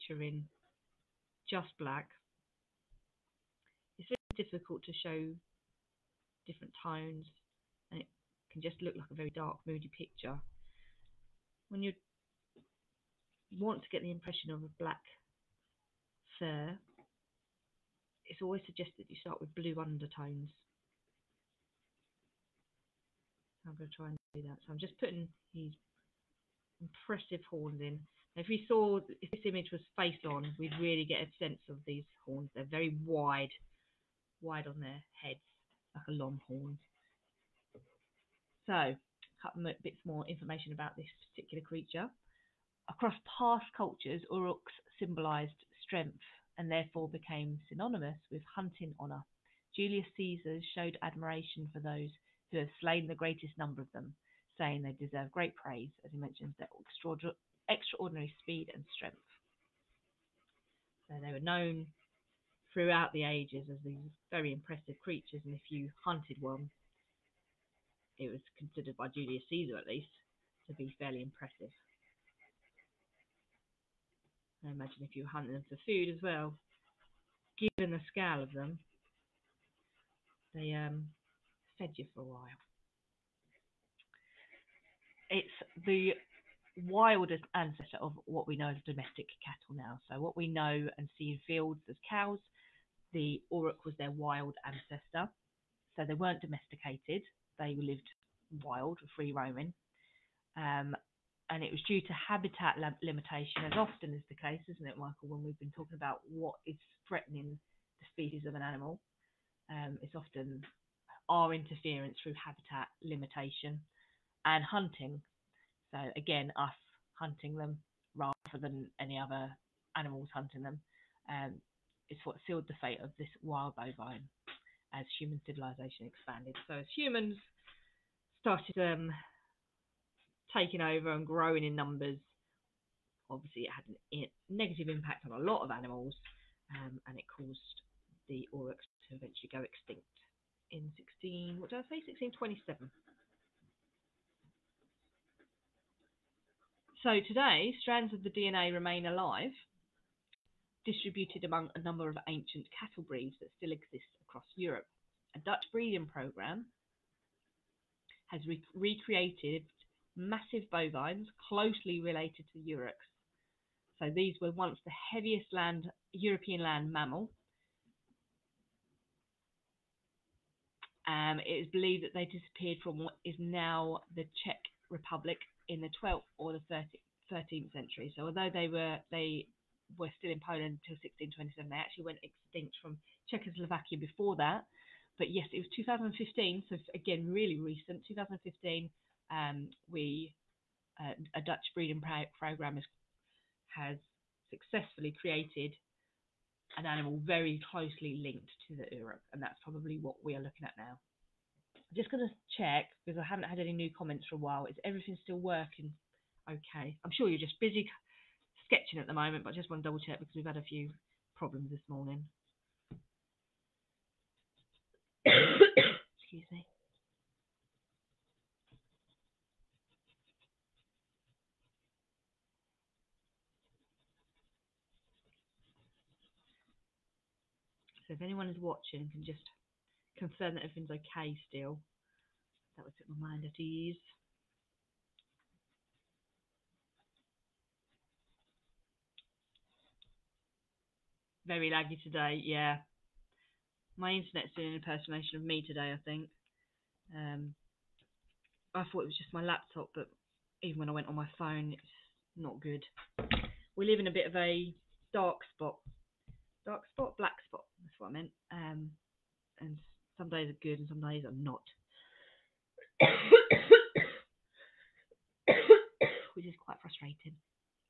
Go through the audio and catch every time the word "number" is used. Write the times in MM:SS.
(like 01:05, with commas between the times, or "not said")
00:53, 02:11, 02:31.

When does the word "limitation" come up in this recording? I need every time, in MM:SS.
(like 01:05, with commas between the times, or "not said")
01:43, 01:53.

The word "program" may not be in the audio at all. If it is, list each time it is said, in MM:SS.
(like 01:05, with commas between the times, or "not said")
02:36, 03:12.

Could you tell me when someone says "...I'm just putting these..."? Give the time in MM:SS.
00:24.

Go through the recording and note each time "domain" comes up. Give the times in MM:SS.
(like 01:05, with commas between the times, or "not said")
not said.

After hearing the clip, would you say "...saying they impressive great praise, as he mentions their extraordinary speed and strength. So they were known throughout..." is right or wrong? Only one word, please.
wrong.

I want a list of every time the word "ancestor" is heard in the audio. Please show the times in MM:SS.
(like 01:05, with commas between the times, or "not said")
01:27, 01:34.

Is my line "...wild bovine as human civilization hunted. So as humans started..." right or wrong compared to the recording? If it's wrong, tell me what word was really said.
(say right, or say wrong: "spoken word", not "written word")
wrong: "expanded", not "hunted".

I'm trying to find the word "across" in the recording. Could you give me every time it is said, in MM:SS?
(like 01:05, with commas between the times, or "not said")
00:42, 02:34.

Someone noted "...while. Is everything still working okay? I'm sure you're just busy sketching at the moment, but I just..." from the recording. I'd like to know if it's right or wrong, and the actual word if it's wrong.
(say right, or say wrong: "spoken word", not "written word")
right.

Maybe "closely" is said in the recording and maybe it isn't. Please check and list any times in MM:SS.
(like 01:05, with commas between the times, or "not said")
02:41, 03:17.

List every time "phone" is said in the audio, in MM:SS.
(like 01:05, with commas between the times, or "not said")
04:11.